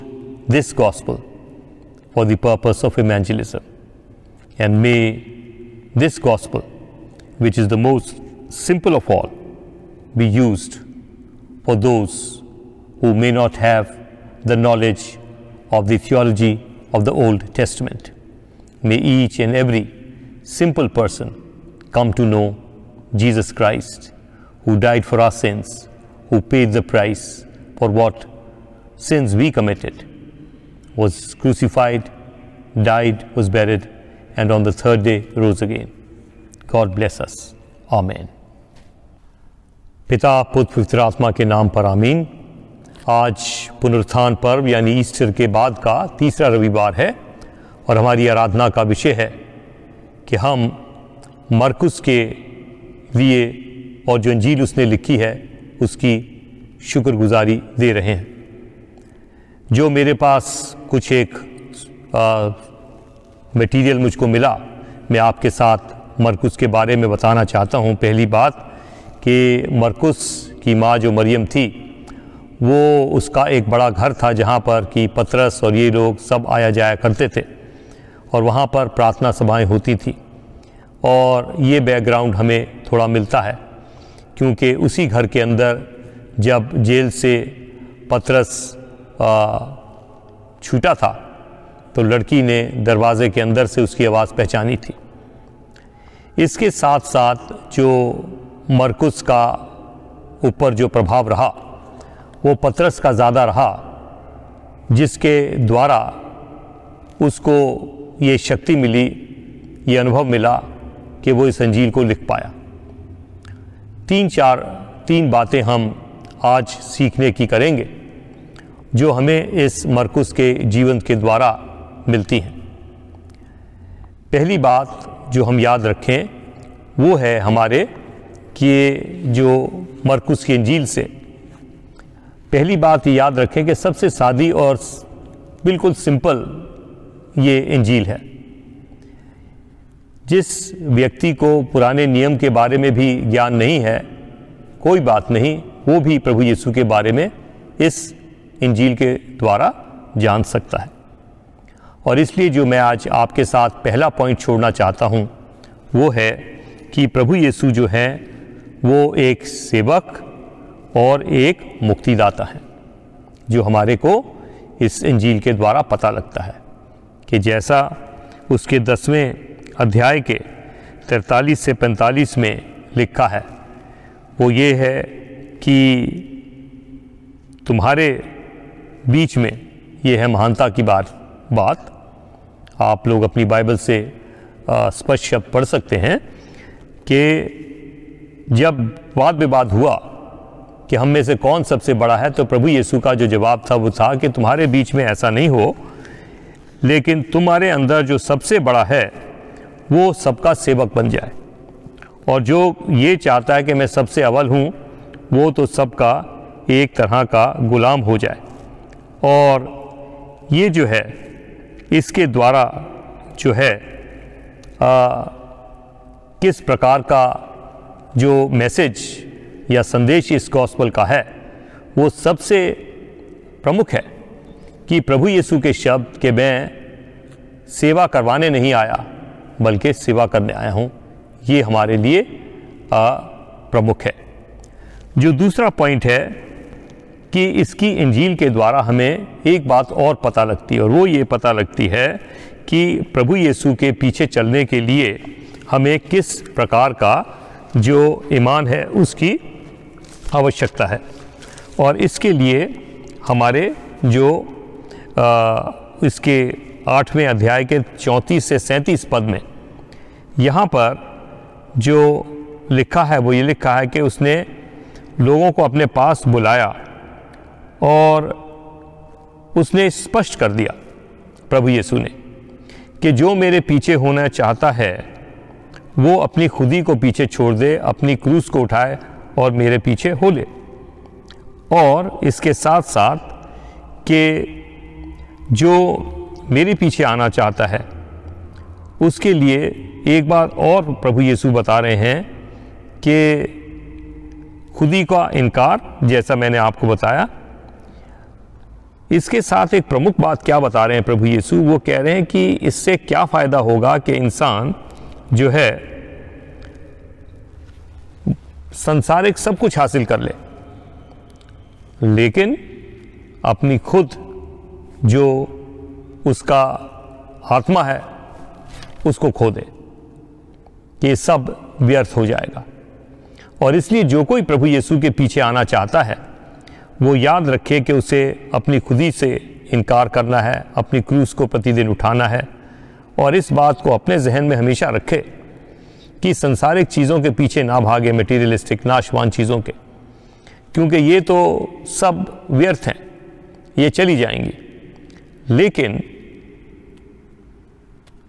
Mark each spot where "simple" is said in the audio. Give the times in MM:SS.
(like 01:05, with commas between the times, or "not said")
00:08, 00:20.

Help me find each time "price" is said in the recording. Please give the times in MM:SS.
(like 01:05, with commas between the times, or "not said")
00:26.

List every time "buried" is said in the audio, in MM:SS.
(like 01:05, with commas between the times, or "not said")
00:33.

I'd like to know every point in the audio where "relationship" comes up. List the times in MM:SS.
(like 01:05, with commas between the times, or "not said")
not said.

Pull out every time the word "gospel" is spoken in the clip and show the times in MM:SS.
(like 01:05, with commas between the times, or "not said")
00:00, 00:06.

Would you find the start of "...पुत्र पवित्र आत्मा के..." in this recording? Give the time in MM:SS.
00:40.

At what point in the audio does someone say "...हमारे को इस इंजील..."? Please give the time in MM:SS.
02:43.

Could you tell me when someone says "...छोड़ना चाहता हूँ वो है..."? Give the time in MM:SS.
02:34.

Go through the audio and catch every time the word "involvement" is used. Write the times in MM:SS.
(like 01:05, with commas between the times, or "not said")
not said.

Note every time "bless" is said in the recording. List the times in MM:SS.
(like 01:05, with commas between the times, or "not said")
00:36.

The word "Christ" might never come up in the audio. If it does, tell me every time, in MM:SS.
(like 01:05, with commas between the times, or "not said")
00:23.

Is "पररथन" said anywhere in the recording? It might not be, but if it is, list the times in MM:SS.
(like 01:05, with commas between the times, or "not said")
01:18.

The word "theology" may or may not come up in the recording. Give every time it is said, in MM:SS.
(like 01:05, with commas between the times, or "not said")
00:15.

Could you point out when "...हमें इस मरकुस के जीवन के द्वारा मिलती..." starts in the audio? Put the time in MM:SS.
01:59.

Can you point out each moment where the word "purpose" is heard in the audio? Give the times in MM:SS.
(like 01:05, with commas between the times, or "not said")
00:02.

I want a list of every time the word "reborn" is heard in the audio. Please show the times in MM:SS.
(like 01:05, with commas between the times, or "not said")
not said.